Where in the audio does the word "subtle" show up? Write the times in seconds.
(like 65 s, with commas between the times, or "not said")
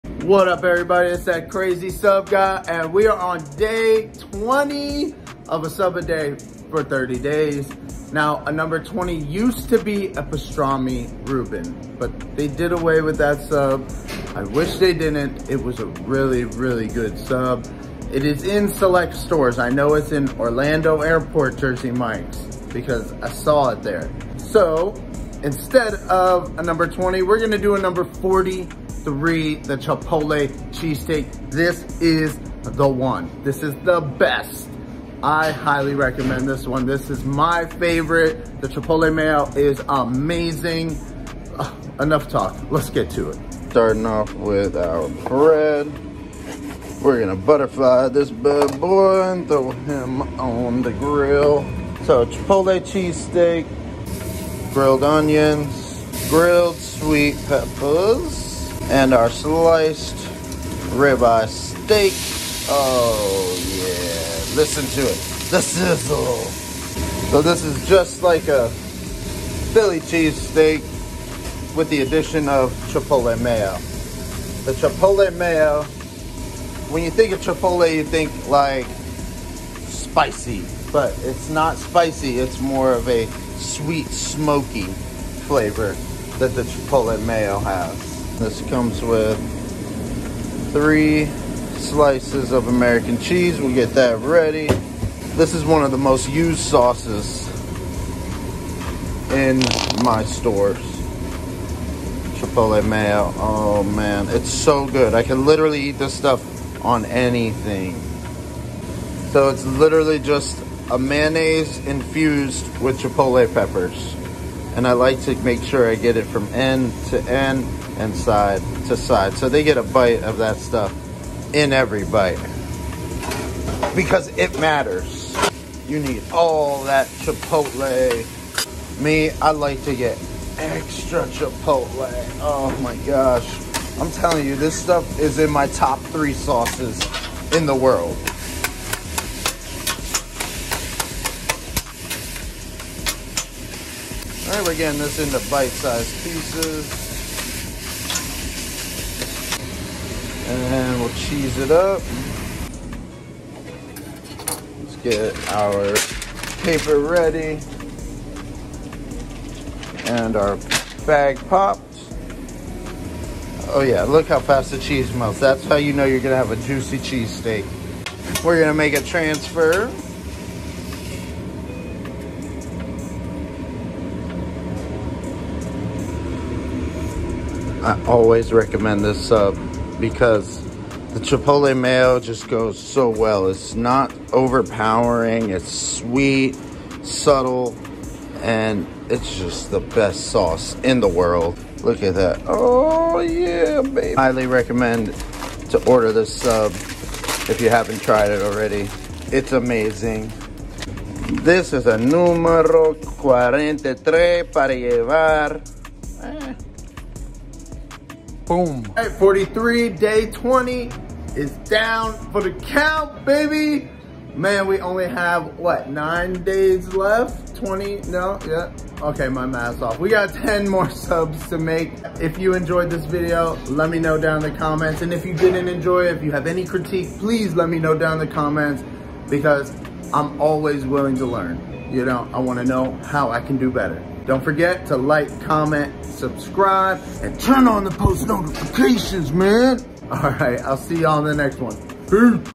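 187 s.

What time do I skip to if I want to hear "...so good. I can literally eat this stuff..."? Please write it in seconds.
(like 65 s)
104 s.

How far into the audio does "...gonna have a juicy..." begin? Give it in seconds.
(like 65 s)
166 s.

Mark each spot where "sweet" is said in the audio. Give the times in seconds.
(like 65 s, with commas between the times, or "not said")
56 s, 83 s, 185 s.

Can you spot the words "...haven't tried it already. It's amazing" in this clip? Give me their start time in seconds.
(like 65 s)
197 s.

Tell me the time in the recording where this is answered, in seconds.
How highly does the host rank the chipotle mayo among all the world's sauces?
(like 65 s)
135 s.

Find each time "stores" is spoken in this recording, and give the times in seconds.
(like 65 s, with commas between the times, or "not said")
19 s, 100 s.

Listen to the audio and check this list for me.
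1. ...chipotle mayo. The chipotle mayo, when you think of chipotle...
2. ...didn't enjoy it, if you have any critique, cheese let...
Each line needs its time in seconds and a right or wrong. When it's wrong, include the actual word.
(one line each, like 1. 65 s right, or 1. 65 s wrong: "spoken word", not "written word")
1. 72 s right
2. 225 s wrong: "please", not "cheese".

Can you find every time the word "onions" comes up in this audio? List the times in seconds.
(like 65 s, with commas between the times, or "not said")
55 s.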